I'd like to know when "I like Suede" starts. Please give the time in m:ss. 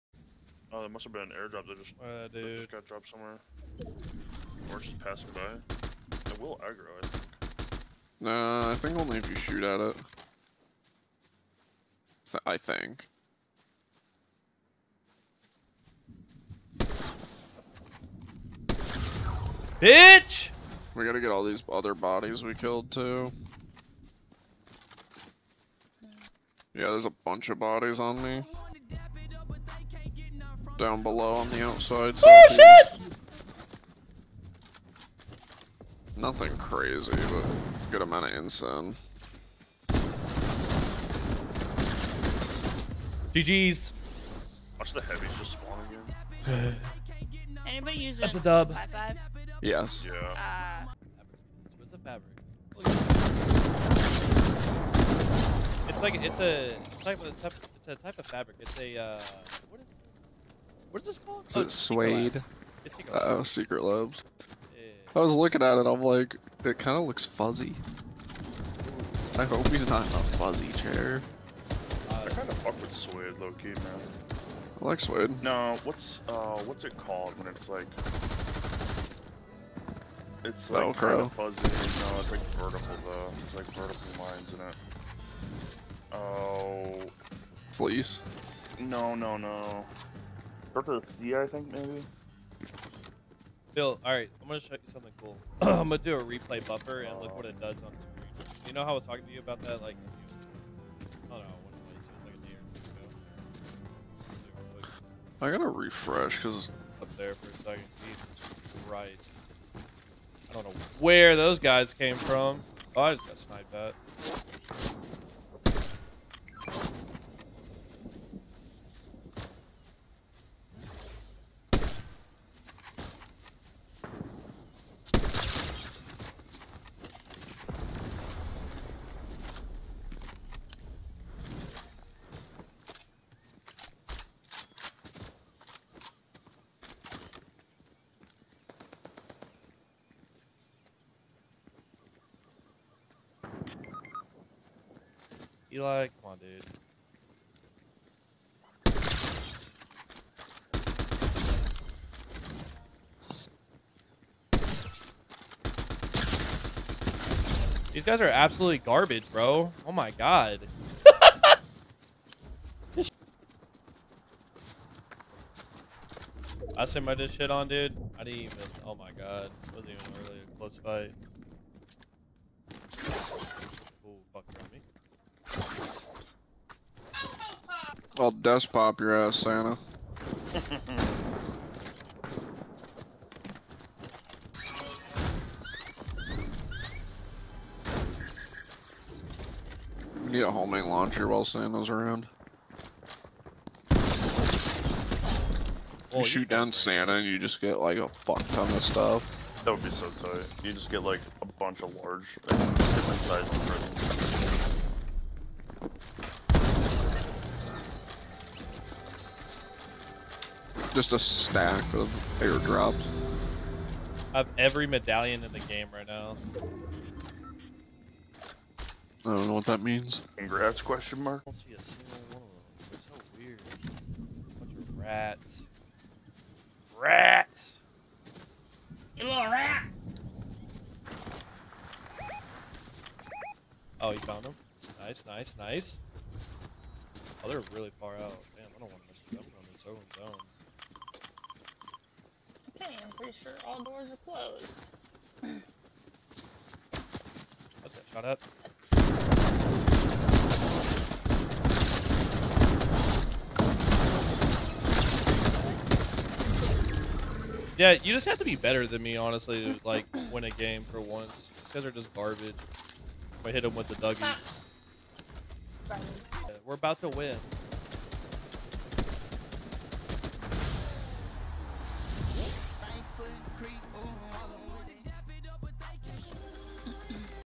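1:14.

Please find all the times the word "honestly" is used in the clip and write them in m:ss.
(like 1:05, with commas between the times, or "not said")
4:19.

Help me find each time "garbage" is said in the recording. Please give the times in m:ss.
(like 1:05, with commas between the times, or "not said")
2:38, 4:22.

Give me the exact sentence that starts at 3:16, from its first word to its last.
You shoot you down Santa and you just get like a fuck ton of stuff.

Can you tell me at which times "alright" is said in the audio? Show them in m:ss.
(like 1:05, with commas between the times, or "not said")
1:34.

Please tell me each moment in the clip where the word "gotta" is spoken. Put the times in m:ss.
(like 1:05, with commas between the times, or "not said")
0:21, 1:45.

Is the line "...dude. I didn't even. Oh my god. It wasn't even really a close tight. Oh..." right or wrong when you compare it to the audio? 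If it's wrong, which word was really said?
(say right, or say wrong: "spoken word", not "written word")
wrong: "fight", not "tight".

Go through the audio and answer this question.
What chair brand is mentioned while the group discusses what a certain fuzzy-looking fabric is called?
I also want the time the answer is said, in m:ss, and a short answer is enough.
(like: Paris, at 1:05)
Secret Labs, at 1:03.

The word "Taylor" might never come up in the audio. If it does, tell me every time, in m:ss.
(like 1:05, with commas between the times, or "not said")
not said.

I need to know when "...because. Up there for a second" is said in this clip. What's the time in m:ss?
1:46.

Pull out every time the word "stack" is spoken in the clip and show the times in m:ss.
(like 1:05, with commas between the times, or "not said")
3:31.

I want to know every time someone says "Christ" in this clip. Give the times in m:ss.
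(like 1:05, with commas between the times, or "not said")
1:48.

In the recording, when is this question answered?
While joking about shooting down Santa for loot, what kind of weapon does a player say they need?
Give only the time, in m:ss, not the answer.
3:10.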